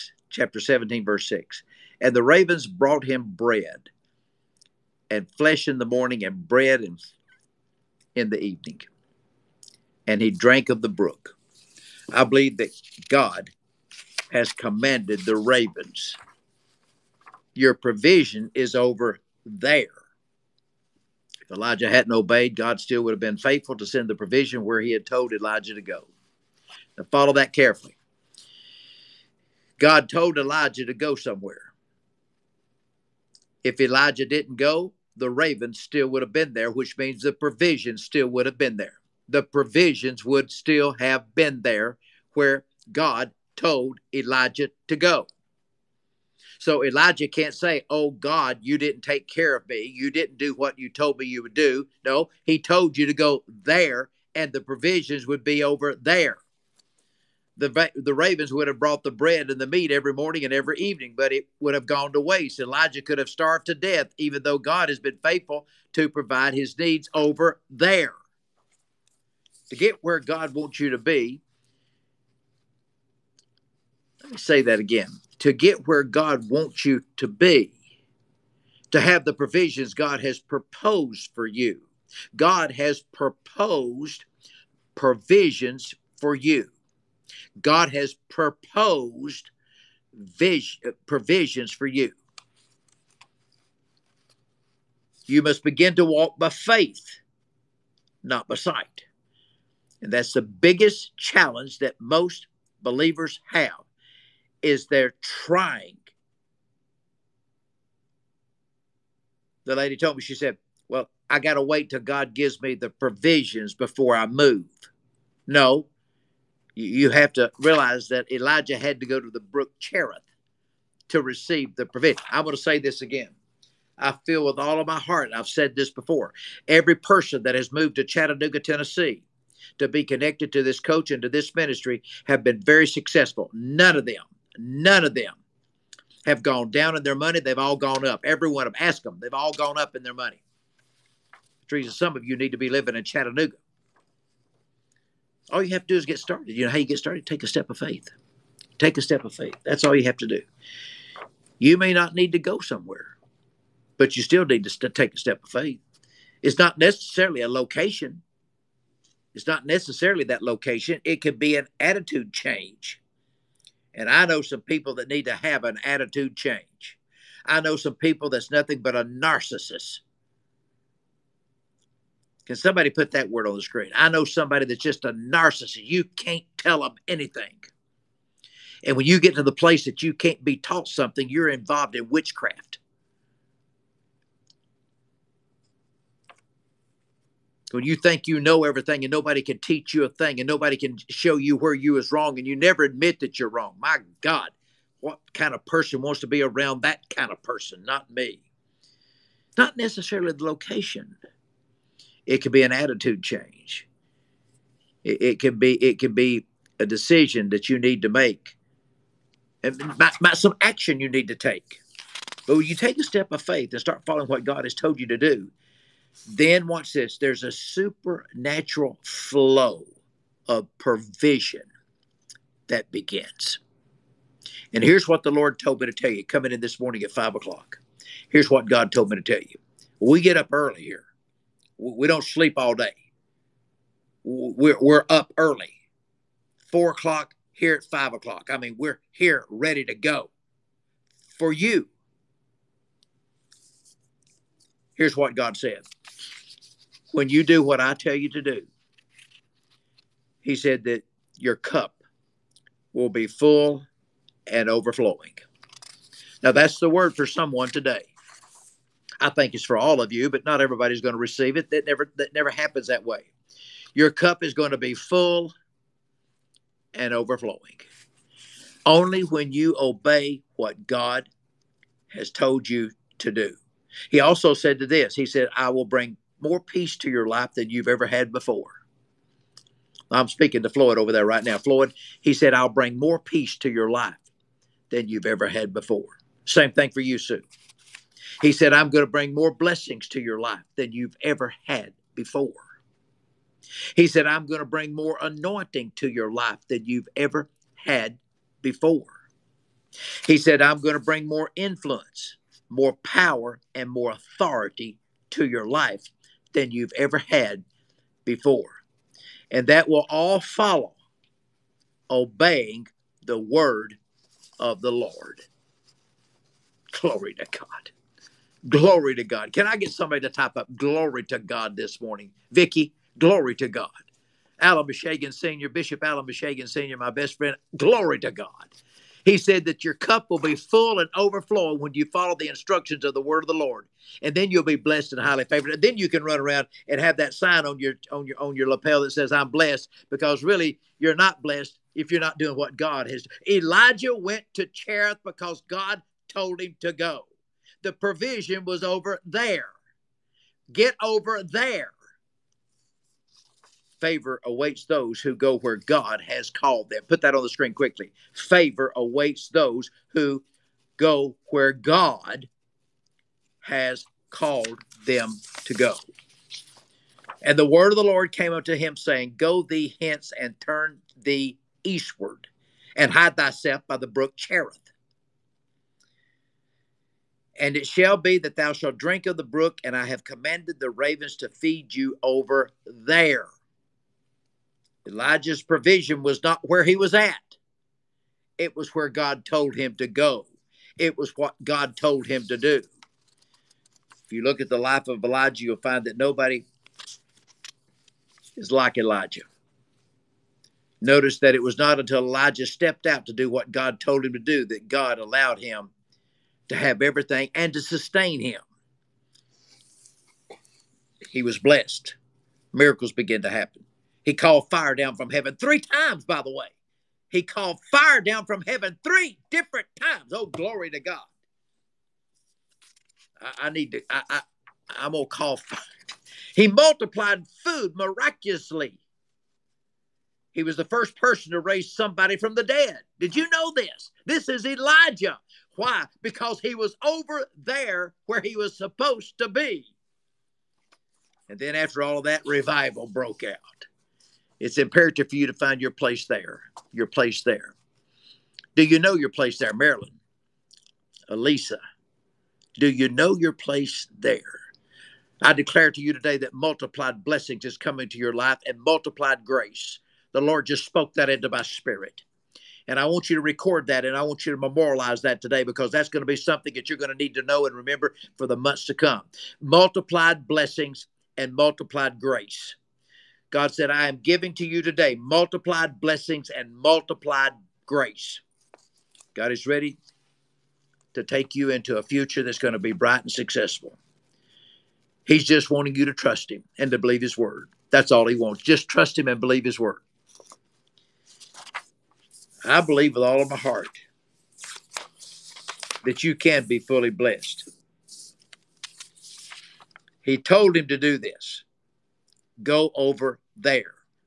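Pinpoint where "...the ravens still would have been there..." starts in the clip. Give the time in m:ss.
0:35.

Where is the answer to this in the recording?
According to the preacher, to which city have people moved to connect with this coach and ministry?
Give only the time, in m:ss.
2:08.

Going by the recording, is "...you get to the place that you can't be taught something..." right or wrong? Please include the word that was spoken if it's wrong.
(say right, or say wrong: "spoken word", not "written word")
right.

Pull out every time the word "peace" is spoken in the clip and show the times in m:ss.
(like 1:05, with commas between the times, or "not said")
4:36, 4:43.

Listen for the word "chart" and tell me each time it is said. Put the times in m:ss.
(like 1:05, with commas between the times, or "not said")
not said.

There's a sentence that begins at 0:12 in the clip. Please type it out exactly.
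I believe that God has commanded the ravens.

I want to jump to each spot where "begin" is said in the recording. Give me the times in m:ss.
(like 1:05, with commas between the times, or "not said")
1:35, 3:42.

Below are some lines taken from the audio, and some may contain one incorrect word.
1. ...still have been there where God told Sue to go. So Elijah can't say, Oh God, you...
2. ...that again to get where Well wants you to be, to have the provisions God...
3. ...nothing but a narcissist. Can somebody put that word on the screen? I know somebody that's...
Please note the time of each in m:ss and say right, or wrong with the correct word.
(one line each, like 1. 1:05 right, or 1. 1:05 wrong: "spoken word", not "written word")
1. 0:40 wrong: "Elijah", not "Sue"
2. 1:14 wrong: "God", not "Well"
3. 2:48 right.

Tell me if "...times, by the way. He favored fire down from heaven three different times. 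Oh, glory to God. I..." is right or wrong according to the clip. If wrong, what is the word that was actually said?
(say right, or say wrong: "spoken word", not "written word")
wrong: "called", not "favored".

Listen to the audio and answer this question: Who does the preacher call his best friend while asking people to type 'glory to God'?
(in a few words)
Bishop Alan Bashagan Sr.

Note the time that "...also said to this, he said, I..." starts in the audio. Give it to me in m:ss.
4:34.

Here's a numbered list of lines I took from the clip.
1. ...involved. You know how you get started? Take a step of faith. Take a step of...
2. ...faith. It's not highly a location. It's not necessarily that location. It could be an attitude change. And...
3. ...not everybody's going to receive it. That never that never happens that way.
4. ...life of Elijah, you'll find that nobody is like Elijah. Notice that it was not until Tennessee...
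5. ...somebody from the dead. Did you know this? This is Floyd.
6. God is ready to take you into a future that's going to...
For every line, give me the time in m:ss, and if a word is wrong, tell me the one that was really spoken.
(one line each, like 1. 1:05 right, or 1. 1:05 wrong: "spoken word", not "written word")
1. 2:26 wrong: "started", not "involved"
2. 2:35 wrong: "necessarily", not "highly"
3. 4:20 right
4. 6:34 wrong: "Elijah", not "Tennessee"
5. 7:11 wrong: "Elijah", not "Floyd"
6. 7:59 right.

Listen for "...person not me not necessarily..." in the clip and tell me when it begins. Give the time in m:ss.
3:17.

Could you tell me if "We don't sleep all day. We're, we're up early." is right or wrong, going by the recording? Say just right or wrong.
right.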